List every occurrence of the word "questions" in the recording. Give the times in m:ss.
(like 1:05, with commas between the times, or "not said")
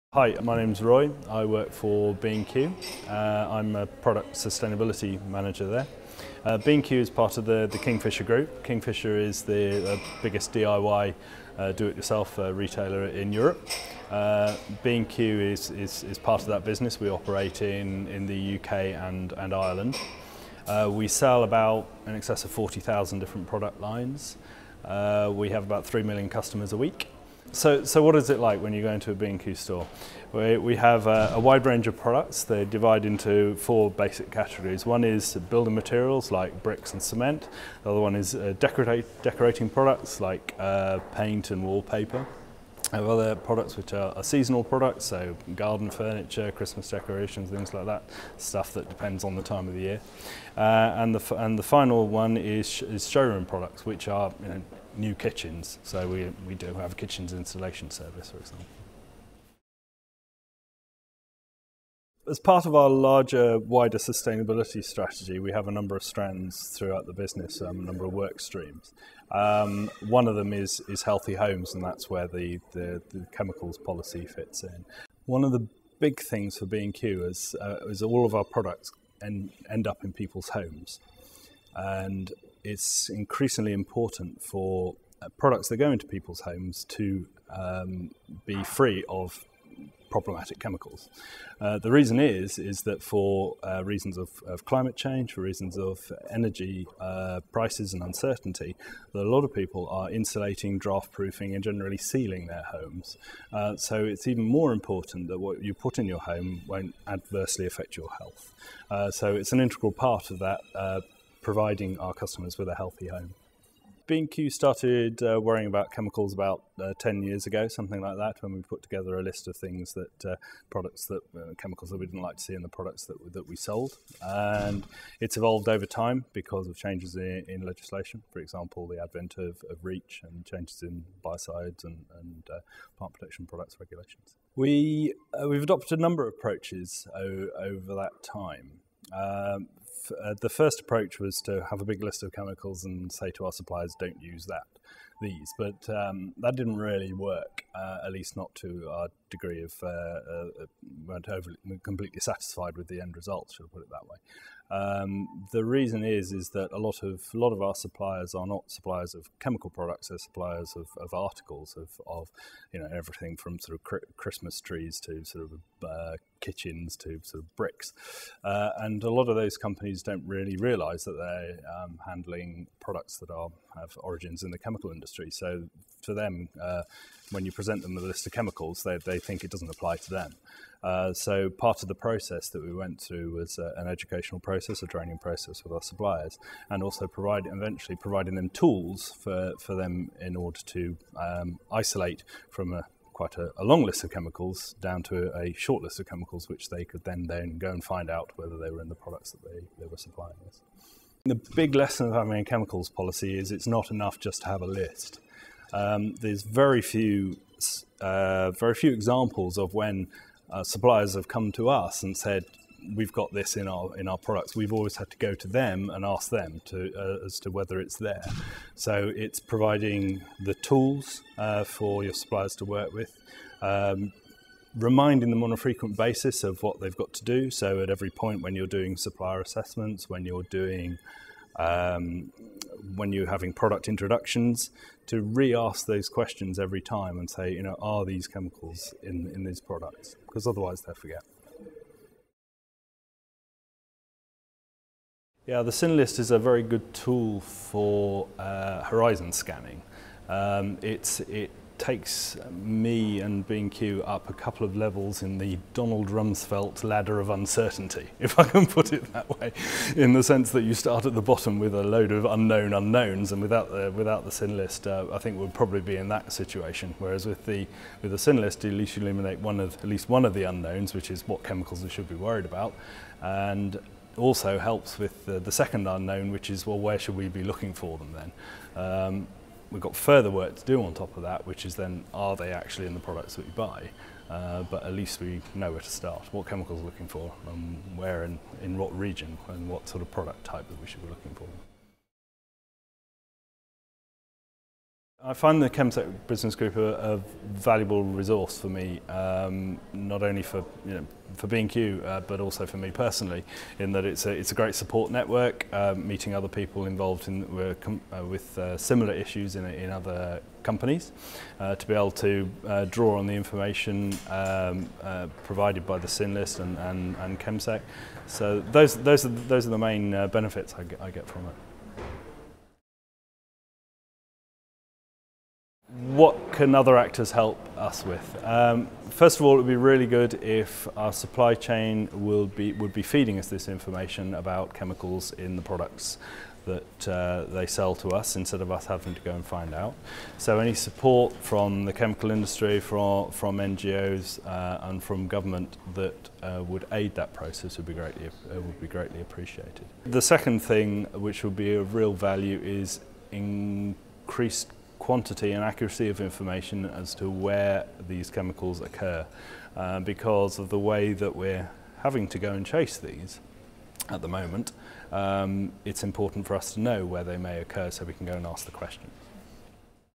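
3:56, 6:08.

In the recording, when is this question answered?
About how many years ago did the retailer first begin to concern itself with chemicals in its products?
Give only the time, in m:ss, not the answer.
1:56.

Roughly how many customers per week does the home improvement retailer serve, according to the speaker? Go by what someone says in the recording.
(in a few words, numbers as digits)
3 million.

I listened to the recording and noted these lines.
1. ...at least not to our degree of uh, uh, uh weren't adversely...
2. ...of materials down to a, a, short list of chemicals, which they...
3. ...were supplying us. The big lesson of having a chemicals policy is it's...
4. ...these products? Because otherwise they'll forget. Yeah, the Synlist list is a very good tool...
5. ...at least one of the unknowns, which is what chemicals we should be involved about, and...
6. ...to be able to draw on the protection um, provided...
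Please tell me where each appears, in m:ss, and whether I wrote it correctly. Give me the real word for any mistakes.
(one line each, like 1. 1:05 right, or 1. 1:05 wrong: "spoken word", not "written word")
1. 2:28 wrong: "overly", not "adversely"
2. 3:14 wrong: "chemicals", not "materials"
3. 3:19 right
4. 3:59 right
5. 4:29 wrong: "worried", not "involved"
6. 5:11 wrong: "information", not "protection".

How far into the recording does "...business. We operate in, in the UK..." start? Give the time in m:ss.
0:16.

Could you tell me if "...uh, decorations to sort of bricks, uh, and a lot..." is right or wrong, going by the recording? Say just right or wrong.
wrong.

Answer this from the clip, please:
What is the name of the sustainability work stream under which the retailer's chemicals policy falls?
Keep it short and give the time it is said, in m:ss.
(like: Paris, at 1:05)
healthy homes, at 1:11.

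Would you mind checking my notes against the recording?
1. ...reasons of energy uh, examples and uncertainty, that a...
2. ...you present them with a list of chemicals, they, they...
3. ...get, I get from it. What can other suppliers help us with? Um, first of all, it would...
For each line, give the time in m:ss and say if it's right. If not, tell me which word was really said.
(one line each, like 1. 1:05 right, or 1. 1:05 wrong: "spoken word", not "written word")
1. 1:35 wrong: "prices", not "examples"
2. 2:57 right
3. 5:20 wrong: "actors", not "suppliers".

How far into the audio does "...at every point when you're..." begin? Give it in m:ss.
3:47.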